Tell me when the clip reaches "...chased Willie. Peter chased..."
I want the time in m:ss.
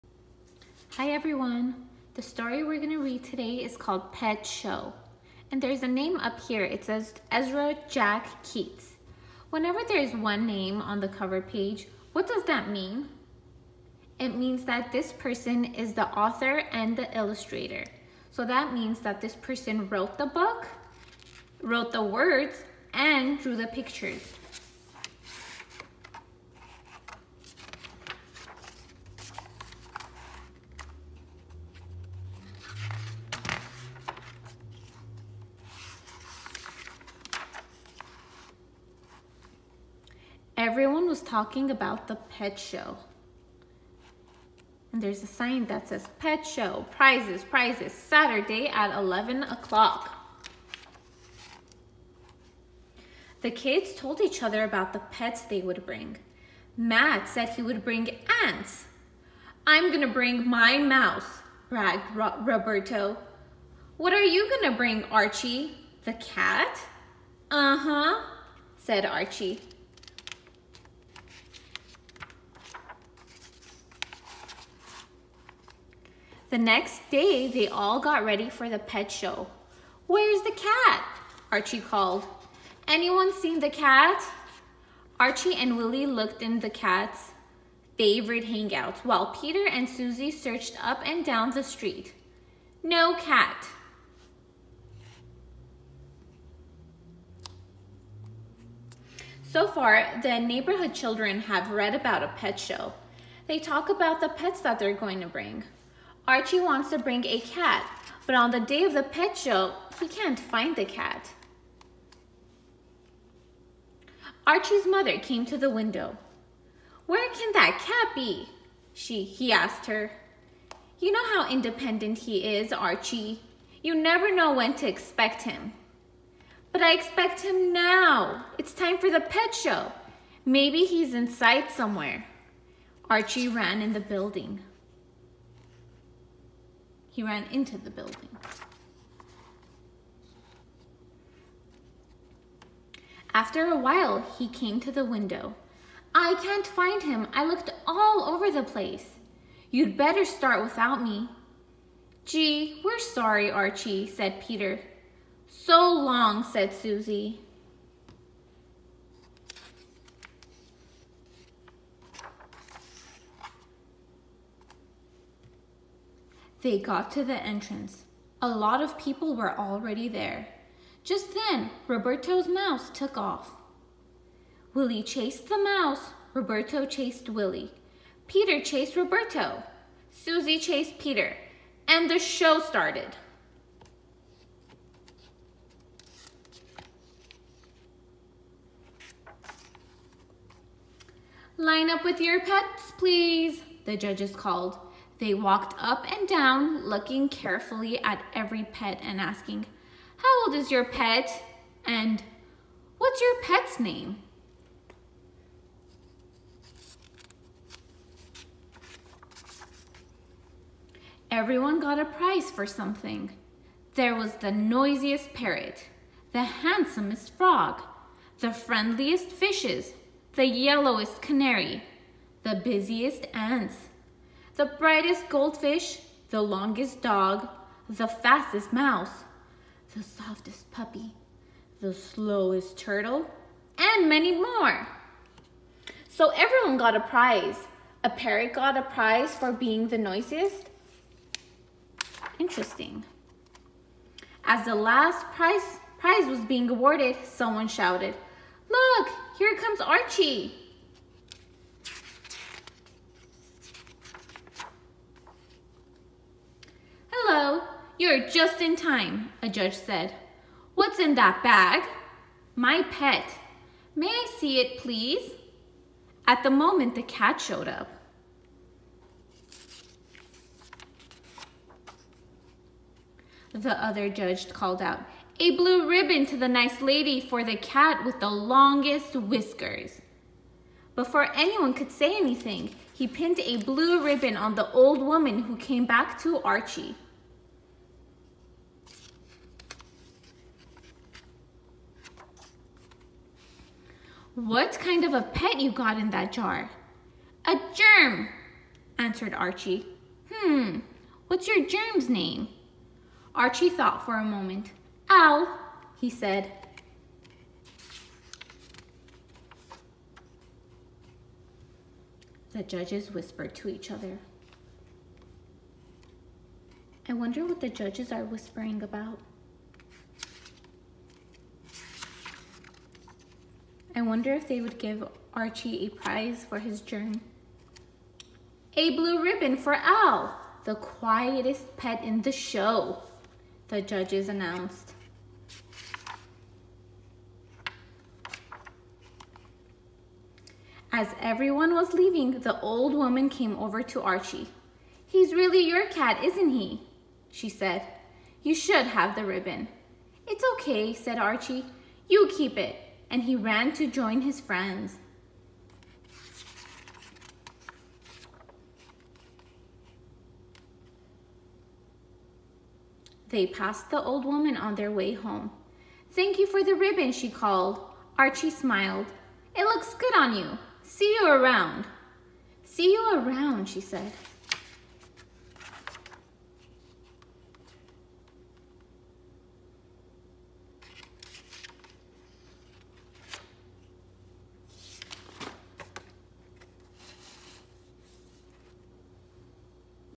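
2:56.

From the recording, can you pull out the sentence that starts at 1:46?
Archie wants to bring a cat, but on the day of the pet show, he can't find the cat.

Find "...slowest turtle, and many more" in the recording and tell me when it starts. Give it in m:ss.
3:51.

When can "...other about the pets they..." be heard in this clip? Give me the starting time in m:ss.
0:54.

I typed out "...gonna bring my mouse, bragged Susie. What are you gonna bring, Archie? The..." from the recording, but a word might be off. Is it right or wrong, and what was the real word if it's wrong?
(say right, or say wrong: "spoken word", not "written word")
wrong: "Roberto", not "Susie".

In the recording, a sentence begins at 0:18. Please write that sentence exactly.
So that means that this person wrote the book, wrote the words, and drew the pictures.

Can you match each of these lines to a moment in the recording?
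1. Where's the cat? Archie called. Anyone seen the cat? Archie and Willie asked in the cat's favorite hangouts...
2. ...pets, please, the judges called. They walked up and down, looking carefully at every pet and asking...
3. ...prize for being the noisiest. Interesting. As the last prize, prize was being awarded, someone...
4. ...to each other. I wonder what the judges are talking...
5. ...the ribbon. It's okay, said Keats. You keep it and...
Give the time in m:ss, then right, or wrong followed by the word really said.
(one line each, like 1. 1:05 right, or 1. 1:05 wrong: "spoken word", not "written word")
1. 1:20 wrong: "looked", not "asked"
2. 3:12 right
3. 3:58 right
4. 5:13 wrong: "whispering", not "talking"
5. 5:49 wrong: "Archie", not "Keats".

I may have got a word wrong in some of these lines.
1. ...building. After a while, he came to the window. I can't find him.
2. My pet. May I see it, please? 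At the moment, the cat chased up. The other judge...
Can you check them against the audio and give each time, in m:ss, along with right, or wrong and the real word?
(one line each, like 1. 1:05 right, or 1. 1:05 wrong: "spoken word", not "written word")
1. 2:17 right
2. 4:22 wrong: "showed", not "chased".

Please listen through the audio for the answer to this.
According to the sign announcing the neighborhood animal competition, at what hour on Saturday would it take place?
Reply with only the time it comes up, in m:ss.
0:48.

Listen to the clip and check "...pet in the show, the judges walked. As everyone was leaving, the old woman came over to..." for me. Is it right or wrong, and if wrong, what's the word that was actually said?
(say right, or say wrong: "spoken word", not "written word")
wrong: "announced", not "walked".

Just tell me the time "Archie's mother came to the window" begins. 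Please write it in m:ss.
1:54.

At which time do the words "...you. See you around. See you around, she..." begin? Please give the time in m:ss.
6:10.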